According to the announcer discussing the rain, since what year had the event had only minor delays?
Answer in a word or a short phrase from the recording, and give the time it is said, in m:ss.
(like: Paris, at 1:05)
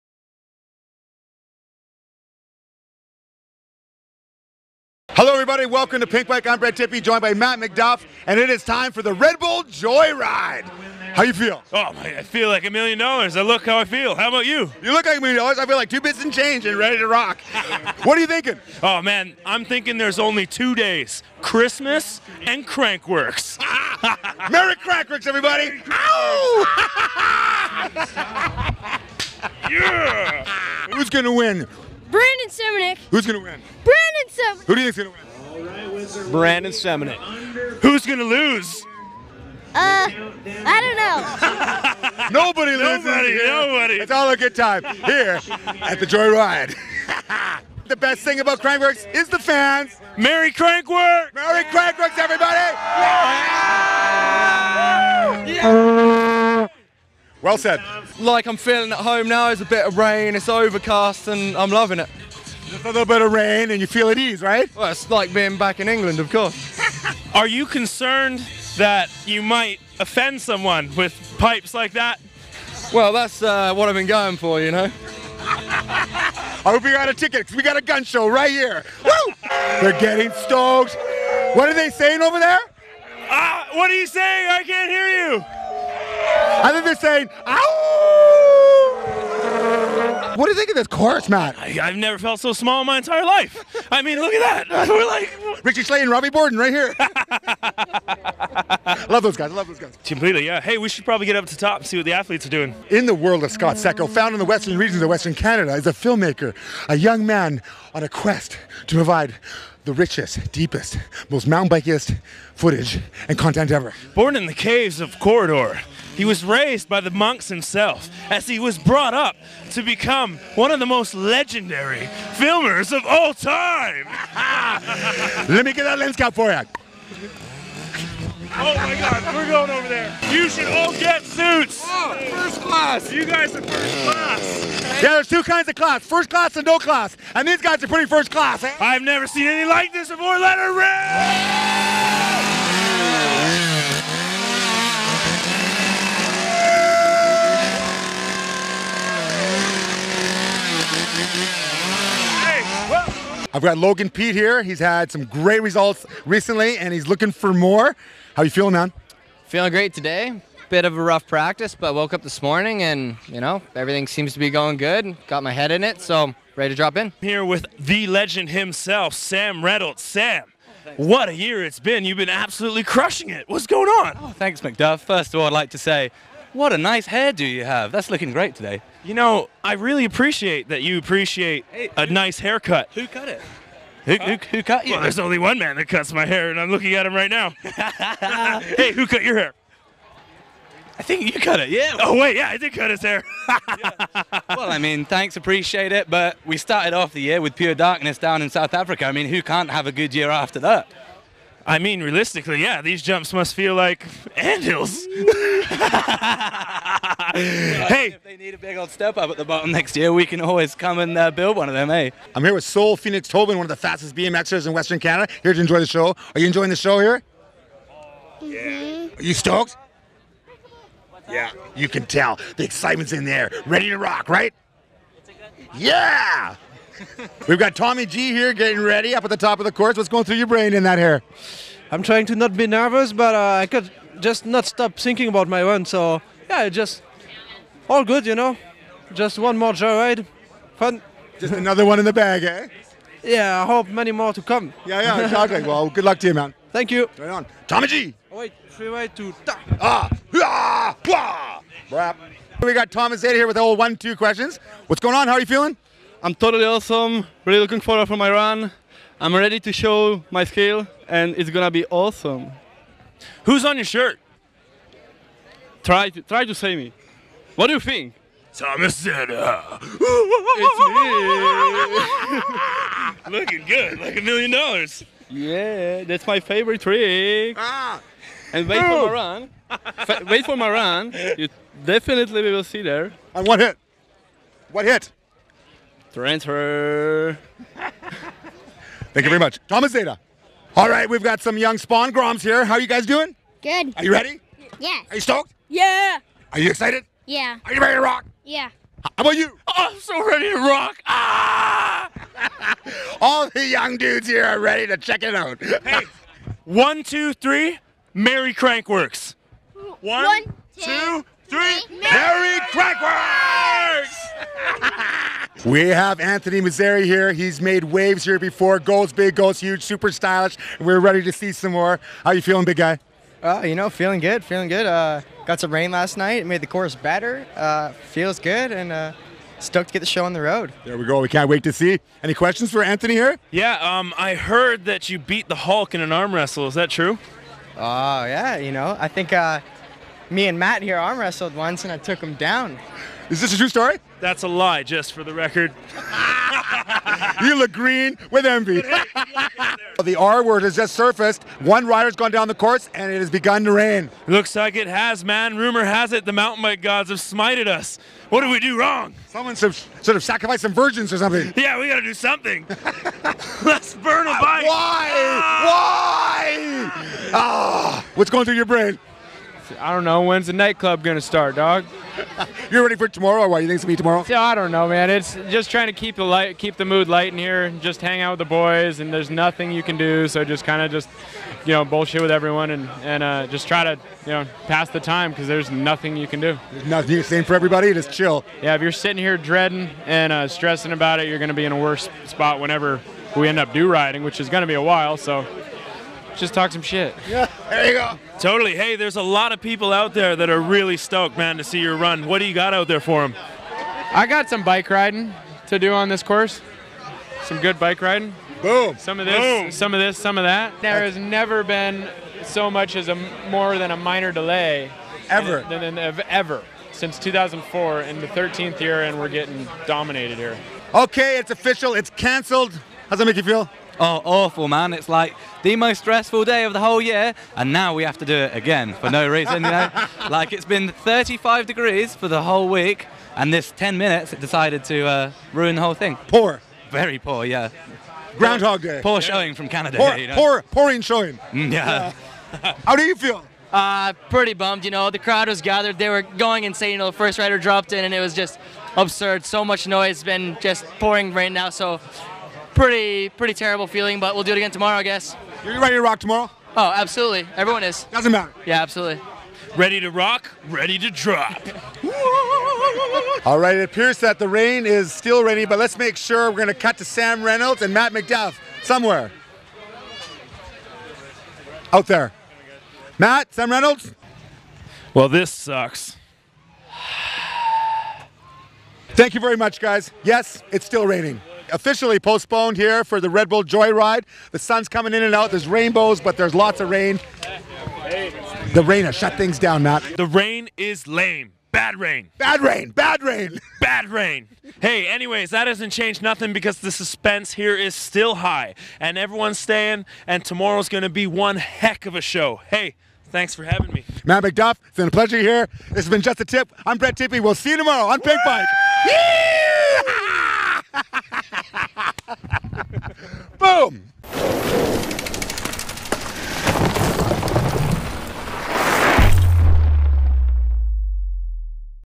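2004, at 6:57.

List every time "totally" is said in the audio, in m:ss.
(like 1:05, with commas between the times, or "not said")
4:16, 6:38.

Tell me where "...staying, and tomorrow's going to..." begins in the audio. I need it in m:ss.
8:19.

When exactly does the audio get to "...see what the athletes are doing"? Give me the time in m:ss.
1:41.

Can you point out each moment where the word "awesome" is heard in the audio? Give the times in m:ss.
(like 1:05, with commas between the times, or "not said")
4:16, 4:21.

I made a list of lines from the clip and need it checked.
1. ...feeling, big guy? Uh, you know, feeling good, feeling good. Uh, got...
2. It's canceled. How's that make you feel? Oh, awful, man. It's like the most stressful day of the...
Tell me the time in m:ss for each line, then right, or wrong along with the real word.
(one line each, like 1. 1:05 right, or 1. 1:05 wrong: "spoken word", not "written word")
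1. 5:22 right
2. 7:01 right.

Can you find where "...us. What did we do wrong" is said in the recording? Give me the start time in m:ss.
5:57.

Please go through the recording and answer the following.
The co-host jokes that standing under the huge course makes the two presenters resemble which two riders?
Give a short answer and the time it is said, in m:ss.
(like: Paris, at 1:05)
Richie Schley and Robbie Bourdon, at 1:35.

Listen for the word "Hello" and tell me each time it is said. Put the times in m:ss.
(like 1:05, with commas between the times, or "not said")
0:05.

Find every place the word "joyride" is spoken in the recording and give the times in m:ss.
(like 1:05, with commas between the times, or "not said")
0:09, 0:46, 3:59, 8:03.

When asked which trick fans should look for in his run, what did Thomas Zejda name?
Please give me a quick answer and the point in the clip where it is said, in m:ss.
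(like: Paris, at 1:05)
Transfer, at 4:46.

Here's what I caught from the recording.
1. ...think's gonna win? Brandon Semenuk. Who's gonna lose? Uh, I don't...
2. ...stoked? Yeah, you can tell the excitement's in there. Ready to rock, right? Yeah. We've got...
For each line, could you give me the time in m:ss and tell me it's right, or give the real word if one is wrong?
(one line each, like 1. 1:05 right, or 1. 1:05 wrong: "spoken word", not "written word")
1. 0:34 right
2. 3:39 right.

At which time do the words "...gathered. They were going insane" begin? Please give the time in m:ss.
7:25.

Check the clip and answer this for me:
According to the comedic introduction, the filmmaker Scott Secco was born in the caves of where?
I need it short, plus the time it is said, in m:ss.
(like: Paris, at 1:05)
Corridor, at 1:55.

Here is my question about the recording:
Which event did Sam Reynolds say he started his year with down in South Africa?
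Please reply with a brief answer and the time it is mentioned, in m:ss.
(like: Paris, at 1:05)
Pure Darkness, at 3:17.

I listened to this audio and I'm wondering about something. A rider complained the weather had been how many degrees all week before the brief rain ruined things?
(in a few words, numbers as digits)
35.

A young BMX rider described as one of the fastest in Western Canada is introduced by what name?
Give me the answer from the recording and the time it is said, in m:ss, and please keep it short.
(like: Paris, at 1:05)
Soul Phoenix Tobin, at 3:32.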